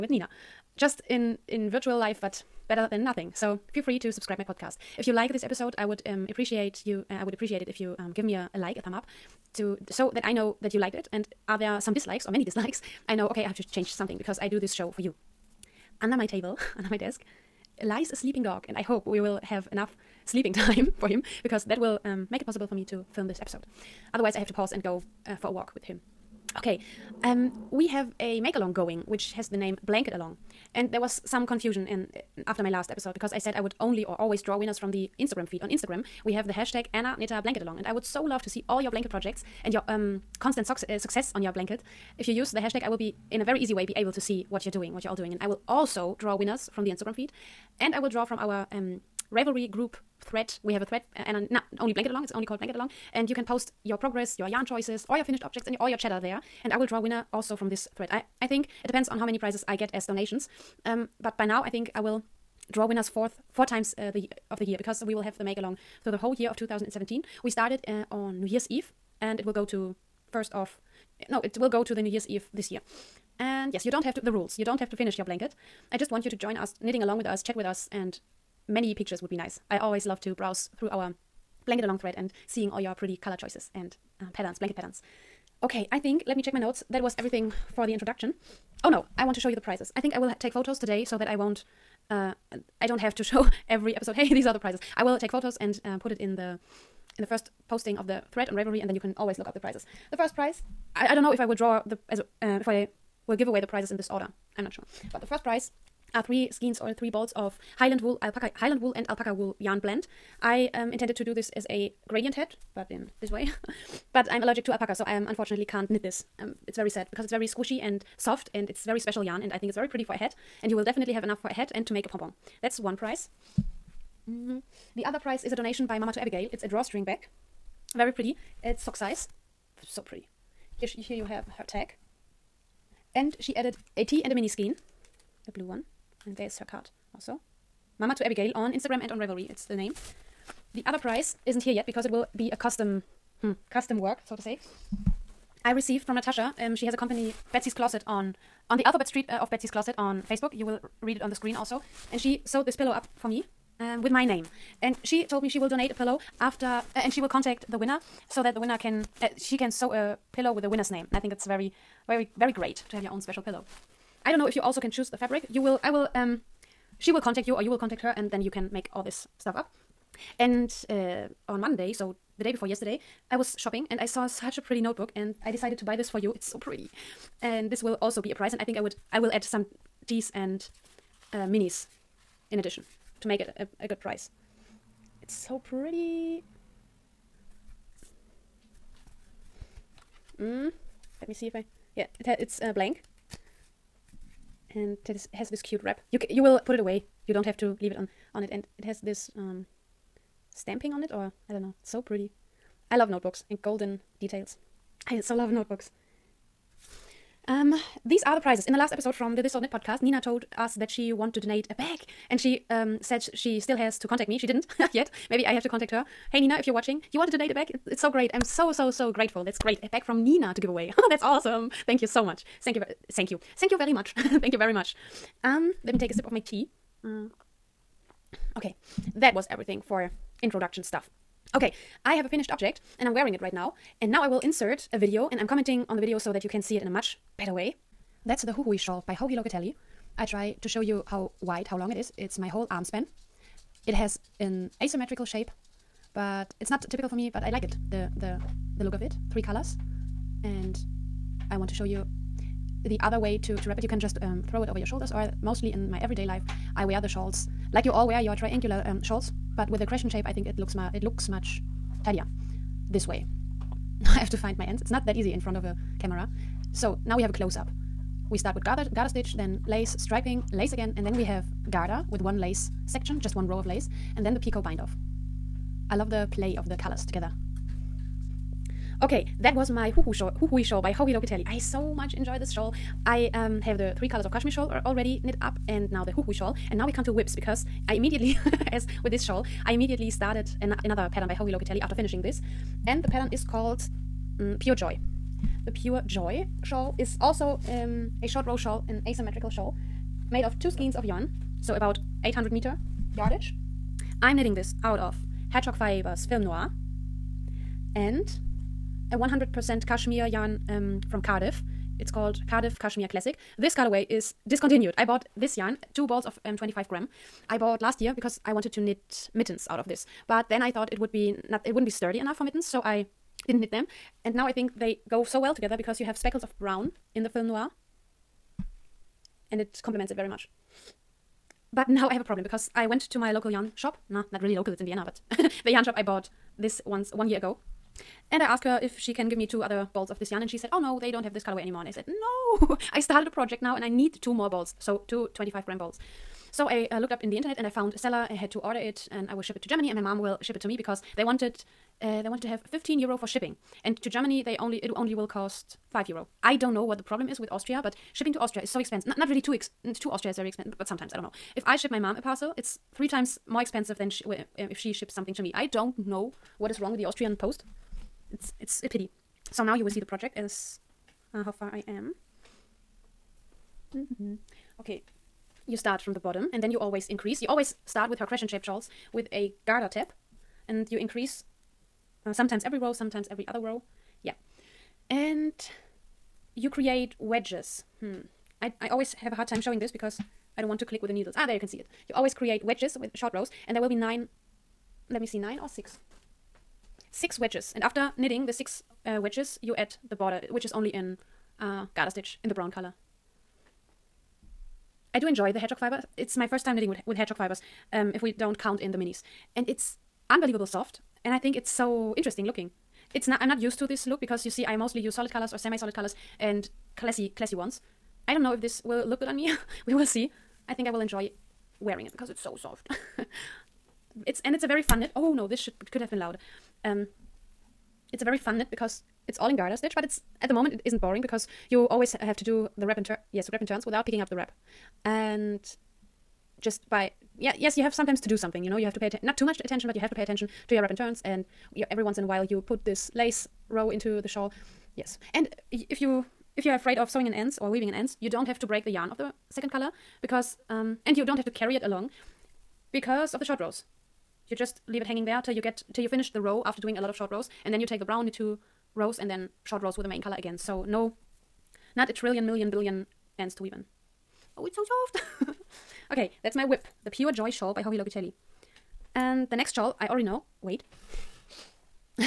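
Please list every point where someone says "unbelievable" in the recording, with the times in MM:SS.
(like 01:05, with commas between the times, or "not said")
06:50.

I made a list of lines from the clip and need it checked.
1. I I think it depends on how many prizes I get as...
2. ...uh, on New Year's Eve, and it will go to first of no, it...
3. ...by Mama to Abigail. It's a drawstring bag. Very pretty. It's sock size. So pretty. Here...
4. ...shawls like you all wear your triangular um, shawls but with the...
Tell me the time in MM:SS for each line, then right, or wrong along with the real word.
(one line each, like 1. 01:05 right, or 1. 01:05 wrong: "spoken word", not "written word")
1. 00:58 right
2. 01:07 right
3. 02:05 right
4. 04:17 right.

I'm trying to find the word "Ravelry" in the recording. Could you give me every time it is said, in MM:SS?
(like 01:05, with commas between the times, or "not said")
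00:49, 01:38, 02:19.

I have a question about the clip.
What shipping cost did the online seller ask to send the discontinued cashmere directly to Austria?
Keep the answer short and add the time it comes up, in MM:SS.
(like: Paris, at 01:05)
15 euro, at 05:52.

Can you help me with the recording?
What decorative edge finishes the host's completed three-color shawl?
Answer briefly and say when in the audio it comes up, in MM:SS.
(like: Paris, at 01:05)
picot bind off, at 04:34.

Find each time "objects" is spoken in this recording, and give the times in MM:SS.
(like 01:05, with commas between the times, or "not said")
00:55, 03:52.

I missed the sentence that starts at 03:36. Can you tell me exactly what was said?
Hey Nina, if you're watching, you wanted to date a back?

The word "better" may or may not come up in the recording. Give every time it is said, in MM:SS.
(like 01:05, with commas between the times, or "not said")
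00:02, 03:57.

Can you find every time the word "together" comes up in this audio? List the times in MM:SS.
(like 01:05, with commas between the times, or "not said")
04:37, 05:25.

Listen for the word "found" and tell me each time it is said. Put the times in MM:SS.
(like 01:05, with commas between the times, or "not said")
05:47.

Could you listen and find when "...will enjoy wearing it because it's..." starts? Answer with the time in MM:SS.
07:00.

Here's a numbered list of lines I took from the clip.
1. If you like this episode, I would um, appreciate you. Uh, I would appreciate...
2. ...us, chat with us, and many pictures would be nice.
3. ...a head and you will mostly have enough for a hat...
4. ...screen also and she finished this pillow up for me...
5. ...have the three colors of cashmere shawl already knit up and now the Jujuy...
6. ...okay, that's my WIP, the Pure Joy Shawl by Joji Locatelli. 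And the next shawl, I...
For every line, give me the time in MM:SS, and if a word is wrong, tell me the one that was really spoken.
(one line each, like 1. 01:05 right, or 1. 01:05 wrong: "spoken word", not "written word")
1. 00:04 right
2. 01:17 right
3. 02:00 wrong: "definitely", not "mostly"
4. 02:31 wrong: "sewed", not "finished"
5. 04:43 right
6. 07:46 right.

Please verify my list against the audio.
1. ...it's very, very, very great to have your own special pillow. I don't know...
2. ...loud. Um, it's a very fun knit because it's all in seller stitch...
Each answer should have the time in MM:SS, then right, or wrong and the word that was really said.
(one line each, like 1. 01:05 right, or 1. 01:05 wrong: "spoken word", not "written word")
1. 02:41 right
2. 07:06 wrong: "garter", not "seller".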